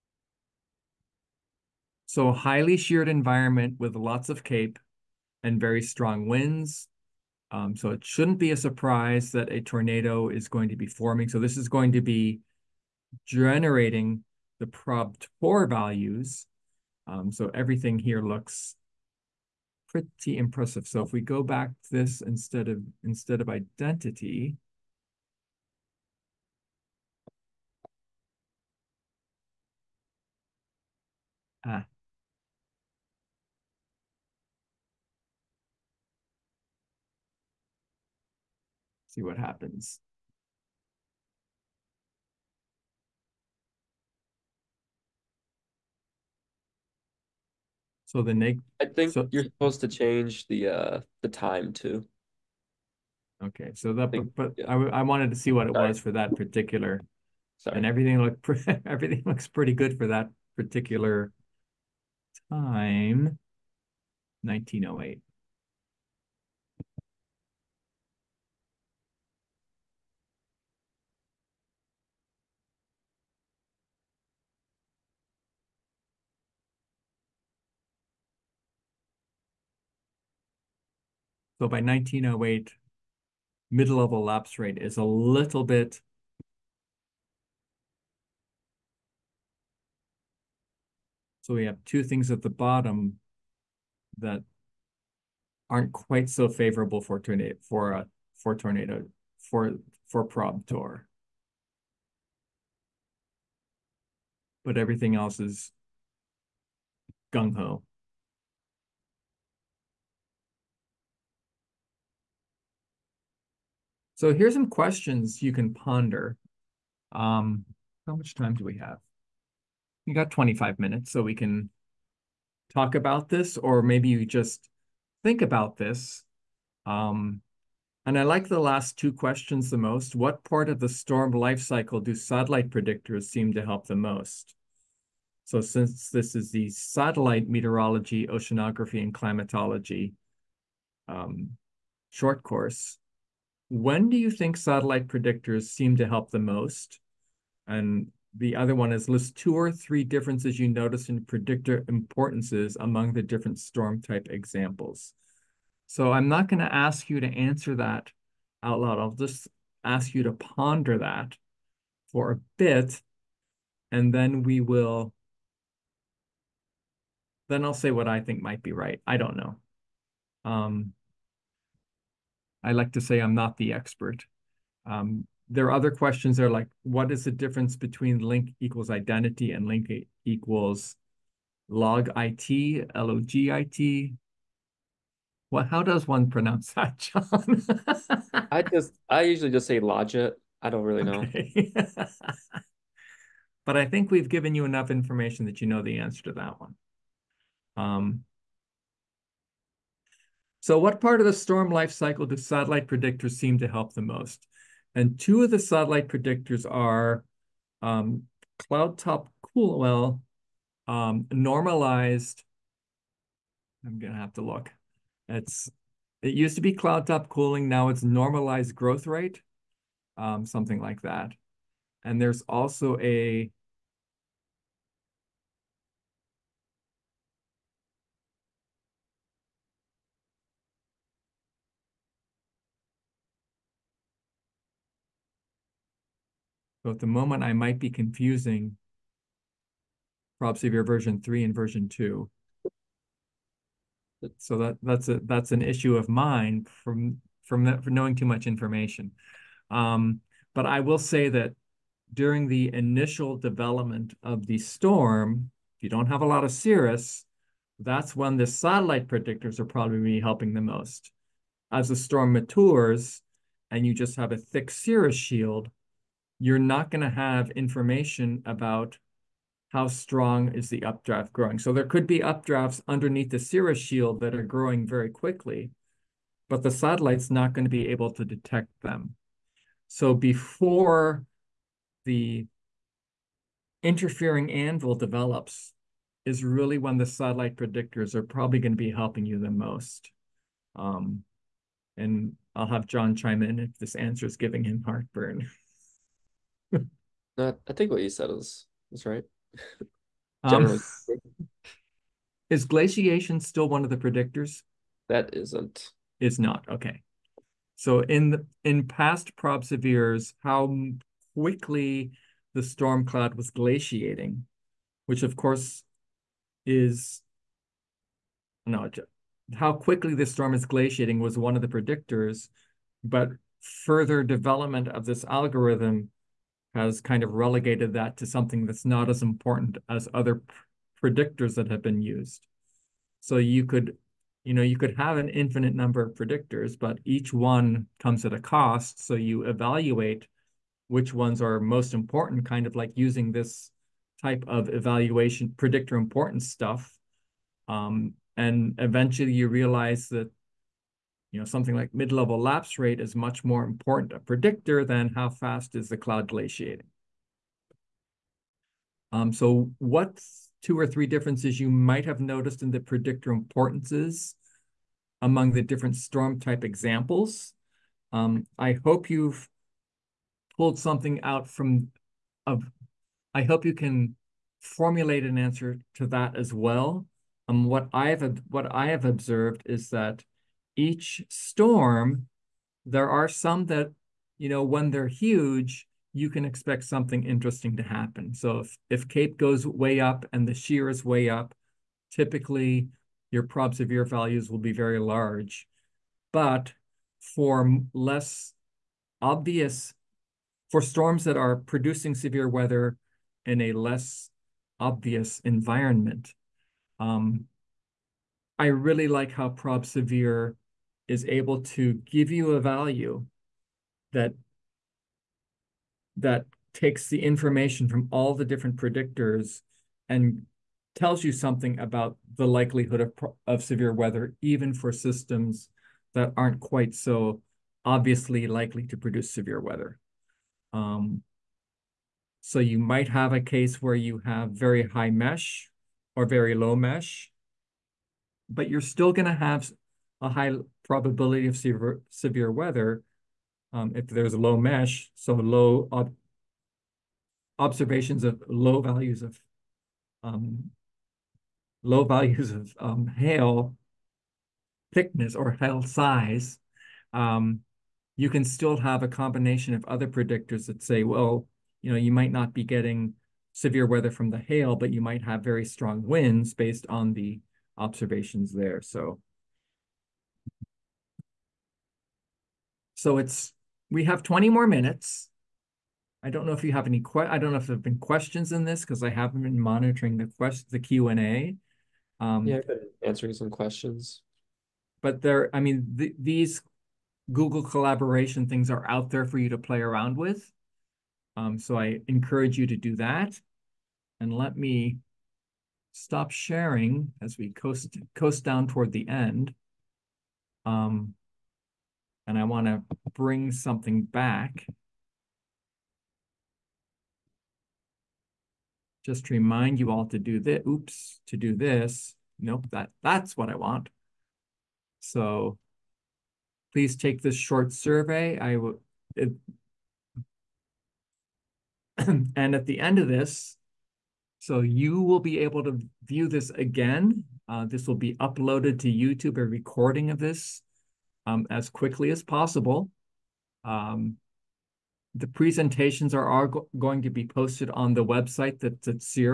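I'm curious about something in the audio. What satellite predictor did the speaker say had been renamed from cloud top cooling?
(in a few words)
normalized growth rate.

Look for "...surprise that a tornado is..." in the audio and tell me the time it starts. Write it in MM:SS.
00:08.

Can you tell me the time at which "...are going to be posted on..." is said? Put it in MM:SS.
08:56.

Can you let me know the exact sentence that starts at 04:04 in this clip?
So that that's a that's an issue of mine from from that, from knowing too much information.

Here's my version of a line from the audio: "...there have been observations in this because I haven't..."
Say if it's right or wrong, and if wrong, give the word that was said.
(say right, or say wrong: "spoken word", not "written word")
wrong: "questions", not "observations".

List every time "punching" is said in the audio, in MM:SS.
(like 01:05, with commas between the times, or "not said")
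not said.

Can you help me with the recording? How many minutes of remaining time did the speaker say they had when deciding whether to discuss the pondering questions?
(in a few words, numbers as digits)
25.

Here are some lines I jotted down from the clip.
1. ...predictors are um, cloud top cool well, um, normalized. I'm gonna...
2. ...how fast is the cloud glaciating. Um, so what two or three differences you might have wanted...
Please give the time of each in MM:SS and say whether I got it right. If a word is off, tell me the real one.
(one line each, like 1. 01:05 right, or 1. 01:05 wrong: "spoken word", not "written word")
1. 03:26 right
2. 05:55 wrong: "noticed", not "wanted".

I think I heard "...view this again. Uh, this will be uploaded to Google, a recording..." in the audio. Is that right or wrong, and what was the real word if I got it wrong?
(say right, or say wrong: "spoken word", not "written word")
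wrong: "YouTube", not "Google".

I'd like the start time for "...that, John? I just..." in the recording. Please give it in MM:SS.
03:06.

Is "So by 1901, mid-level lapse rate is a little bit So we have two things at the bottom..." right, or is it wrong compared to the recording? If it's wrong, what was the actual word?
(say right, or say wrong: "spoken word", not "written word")
wrong: "1908", not "1901".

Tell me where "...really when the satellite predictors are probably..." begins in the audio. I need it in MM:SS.
04:46.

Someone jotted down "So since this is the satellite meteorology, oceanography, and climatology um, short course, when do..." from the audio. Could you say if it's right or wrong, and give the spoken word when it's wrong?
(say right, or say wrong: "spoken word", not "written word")
right.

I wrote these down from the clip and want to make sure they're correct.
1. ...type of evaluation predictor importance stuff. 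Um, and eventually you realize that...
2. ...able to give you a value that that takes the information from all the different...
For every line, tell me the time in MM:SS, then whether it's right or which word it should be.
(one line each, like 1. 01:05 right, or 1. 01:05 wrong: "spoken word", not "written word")
1. 05:44 right
2. 06:51 right.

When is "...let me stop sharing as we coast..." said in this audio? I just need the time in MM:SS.
08:14.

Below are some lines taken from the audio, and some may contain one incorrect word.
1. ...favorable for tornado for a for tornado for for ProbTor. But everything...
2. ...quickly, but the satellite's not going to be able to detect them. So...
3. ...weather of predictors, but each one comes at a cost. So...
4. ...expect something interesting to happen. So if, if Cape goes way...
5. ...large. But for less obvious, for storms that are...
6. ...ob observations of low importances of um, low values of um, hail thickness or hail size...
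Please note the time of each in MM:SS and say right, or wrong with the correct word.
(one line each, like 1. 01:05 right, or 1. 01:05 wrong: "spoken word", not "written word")
1. 01:36 right
2. 04:35 right
3. 05:35 wrong: "number", not "weather"
4. 06:26 right
5. 06:34 right
6. 07:25 wrong: "values", not "importances".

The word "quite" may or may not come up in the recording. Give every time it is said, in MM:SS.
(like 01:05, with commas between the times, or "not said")
01:35, 07:06.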